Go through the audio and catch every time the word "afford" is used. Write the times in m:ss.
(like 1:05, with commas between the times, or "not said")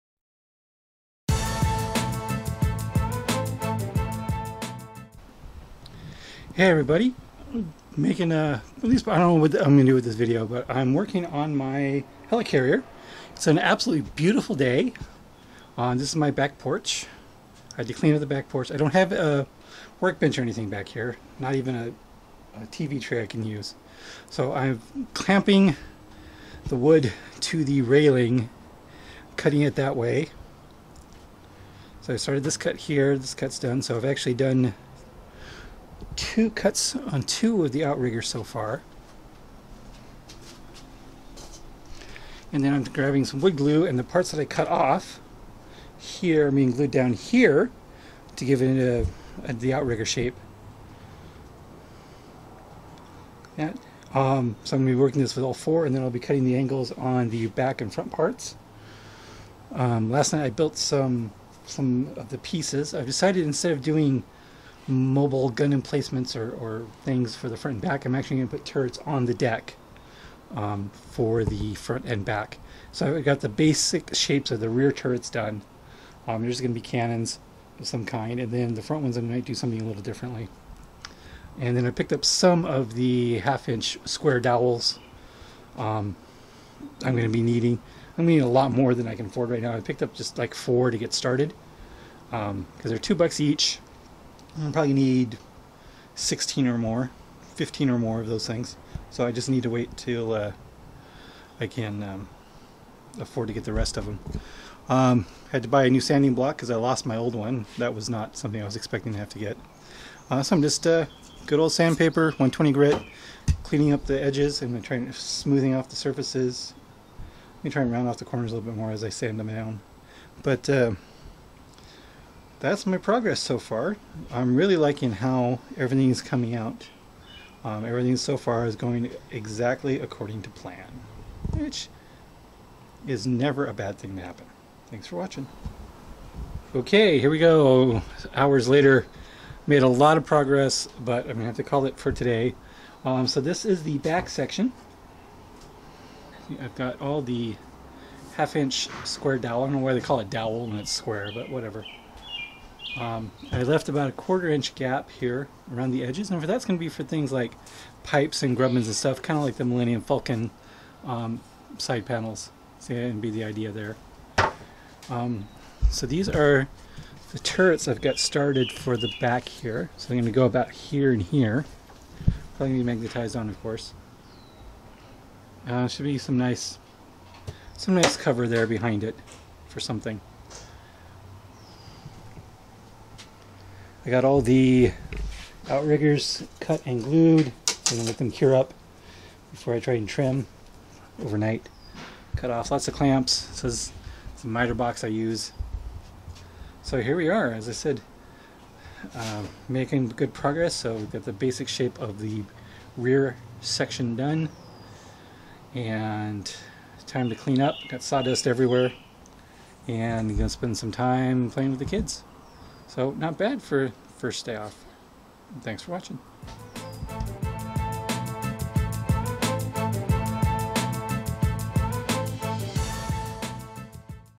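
1:29, 1:43.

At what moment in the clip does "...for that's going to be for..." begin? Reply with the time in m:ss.
2:36.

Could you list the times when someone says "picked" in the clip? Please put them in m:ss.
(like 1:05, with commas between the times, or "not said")
1:21, 1:29.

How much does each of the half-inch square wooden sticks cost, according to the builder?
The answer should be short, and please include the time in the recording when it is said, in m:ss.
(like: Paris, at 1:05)
$2, at 1:32.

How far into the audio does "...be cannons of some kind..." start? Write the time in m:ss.
1:16.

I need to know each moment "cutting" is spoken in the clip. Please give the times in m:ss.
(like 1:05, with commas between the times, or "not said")
0:29, 0:56.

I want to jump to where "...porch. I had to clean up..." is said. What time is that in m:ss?
0:16.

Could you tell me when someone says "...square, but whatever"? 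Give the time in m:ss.
2:30.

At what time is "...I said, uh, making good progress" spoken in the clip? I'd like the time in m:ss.
3:17.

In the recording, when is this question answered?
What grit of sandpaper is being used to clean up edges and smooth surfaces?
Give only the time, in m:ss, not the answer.
1:52.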